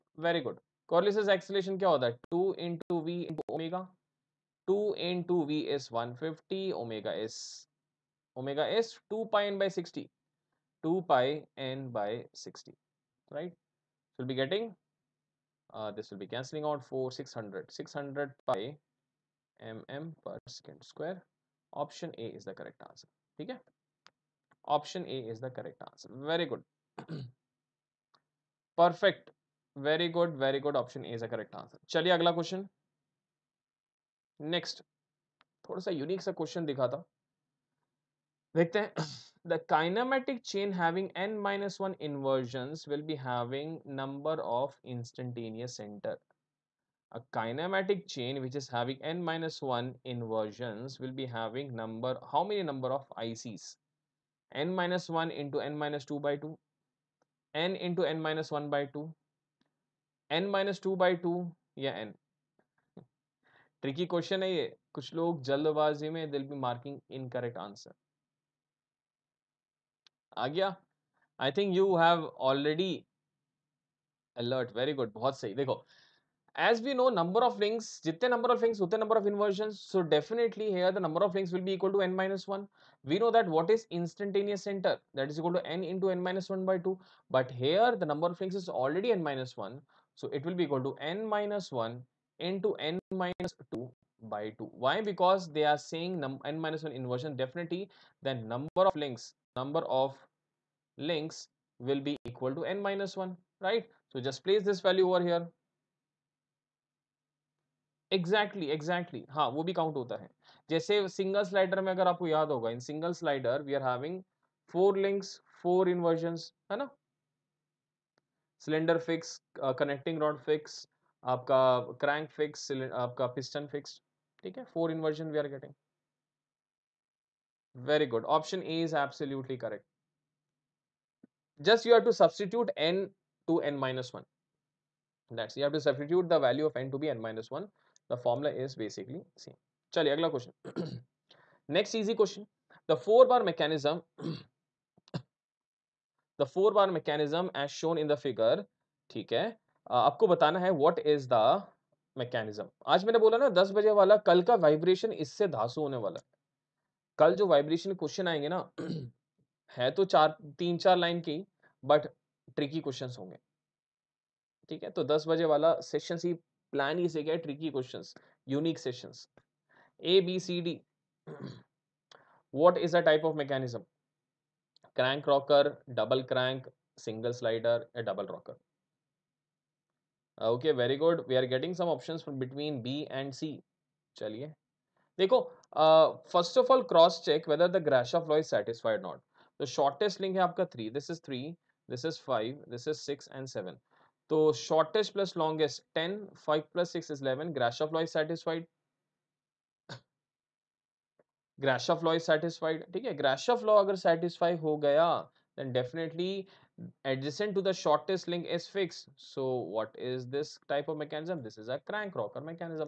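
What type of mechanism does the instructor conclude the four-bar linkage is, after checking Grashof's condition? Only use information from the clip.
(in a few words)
Crank rocker.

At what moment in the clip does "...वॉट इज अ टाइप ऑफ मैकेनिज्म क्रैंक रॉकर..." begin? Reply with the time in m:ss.
2:52.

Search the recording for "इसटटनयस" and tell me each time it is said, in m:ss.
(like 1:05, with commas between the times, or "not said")
0:44, 1:24.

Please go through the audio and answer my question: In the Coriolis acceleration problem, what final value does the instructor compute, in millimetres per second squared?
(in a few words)
600 pi.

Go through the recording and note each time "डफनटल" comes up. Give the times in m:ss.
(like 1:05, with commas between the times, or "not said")
1:20, 3:25.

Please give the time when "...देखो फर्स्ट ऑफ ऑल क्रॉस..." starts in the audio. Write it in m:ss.
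3:05.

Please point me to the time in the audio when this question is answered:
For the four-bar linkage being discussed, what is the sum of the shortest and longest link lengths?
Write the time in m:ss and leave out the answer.
3:14.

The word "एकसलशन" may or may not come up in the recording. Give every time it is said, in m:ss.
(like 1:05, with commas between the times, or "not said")
0:01.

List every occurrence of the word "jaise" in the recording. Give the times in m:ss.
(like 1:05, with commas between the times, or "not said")
1:50.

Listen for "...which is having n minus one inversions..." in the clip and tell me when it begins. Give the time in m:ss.
0:48.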